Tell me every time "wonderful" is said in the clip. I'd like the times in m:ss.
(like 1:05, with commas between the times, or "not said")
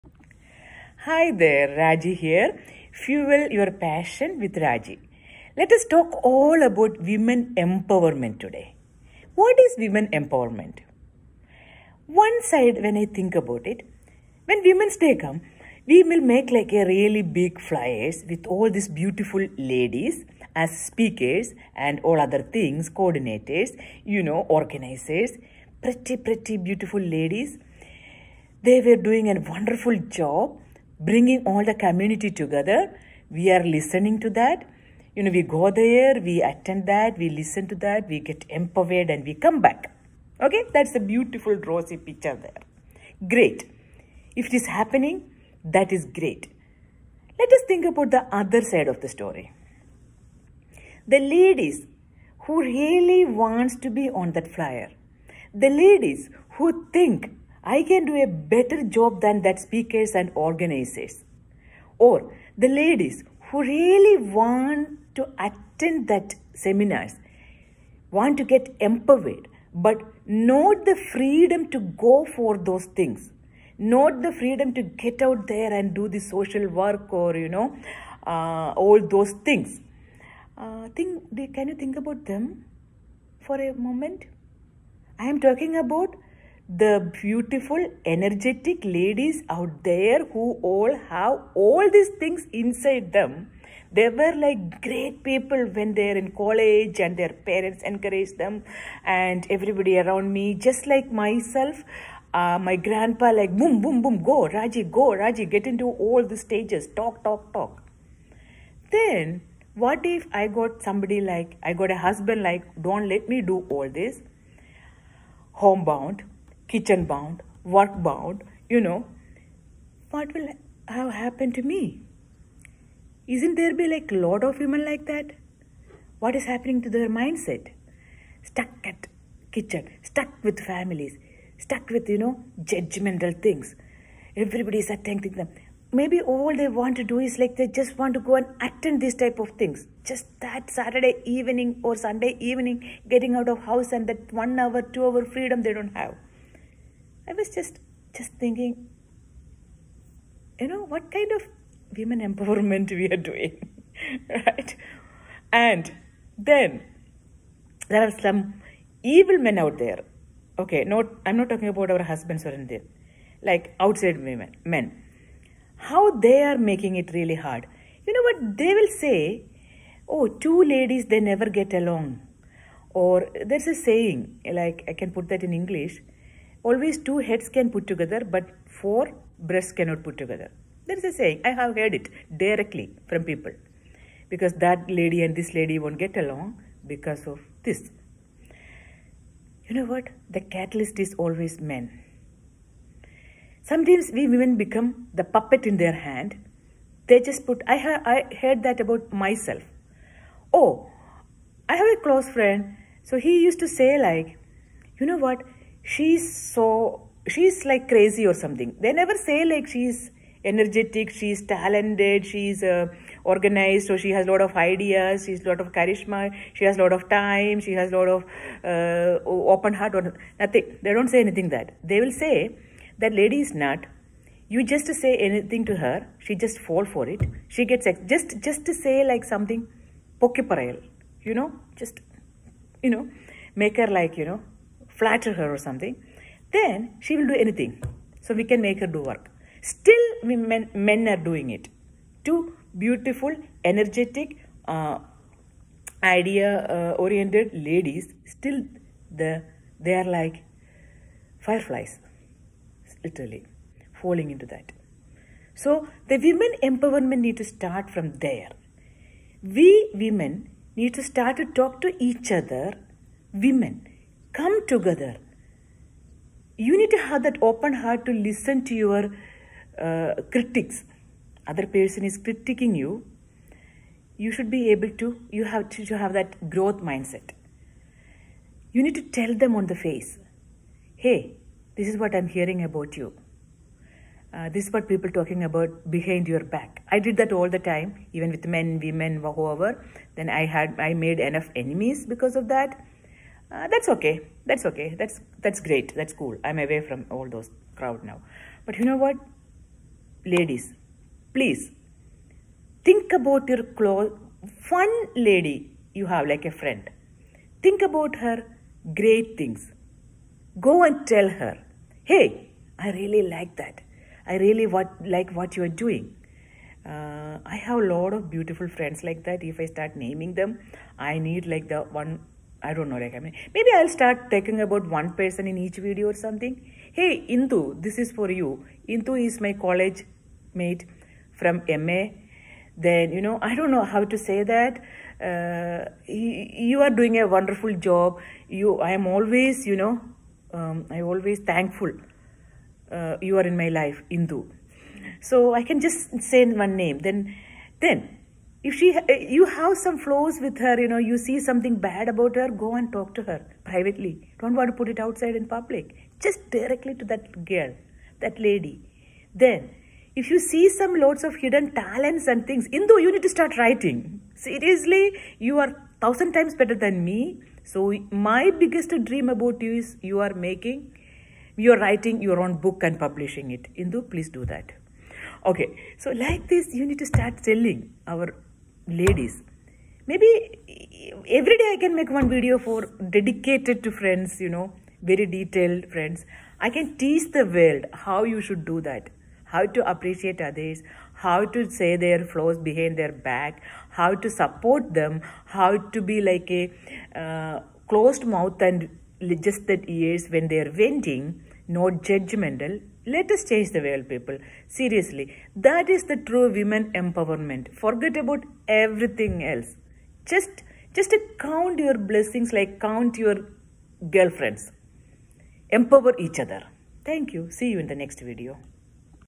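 0:29, 5:37.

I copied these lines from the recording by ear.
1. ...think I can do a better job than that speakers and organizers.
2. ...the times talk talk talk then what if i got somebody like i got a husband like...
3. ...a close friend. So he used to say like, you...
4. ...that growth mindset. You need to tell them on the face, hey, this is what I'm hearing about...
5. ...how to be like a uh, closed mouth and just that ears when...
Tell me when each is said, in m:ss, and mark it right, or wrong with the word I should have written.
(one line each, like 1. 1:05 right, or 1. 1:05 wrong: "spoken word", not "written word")
1. 0:56 right
2. 1:46 wrong: "stages", not "times"
3. 3:21 right
4. 4:36 right
5. 6:35 right.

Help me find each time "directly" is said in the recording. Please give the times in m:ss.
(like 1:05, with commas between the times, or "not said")
3:02, 5:56.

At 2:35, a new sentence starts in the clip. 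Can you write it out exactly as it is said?
And then there are some evil men out there.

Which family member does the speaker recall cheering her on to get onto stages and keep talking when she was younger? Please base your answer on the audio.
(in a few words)
Grandpa.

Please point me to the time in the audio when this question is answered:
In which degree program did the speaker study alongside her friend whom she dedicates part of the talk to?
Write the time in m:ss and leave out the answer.
5:31.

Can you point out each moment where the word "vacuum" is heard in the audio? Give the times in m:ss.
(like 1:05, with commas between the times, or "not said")
not said.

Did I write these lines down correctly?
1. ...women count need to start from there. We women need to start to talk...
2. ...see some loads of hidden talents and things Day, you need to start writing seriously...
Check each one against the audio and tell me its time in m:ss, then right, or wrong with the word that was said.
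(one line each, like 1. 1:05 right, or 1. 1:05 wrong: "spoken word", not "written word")
1. 4:16 wrong: "empowerment", not "count"
2. 6:00 wrong: "Indu", not "Day".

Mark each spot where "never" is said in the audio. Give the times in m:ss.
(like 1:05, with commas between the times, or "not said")
2:51, 3:28.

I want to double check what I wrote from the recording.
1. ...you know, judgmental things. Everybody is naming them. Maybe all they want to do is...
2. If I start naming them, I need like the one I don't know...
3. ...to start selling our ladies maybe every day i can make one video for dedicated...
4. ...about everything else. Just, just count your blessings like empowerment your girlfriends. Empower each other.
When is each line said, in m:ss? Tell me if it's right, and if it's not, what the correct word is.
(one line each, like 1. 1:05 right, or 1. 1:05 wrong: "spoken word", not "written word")
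1. 2:12 wrong: "attending", not "naming"
2. 5:19 right
3. 6:16 right
4. 6:48 wrong: "count", not "empowerment".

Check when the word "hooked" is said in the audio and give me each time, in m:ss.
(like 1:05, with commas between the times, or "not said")
not said.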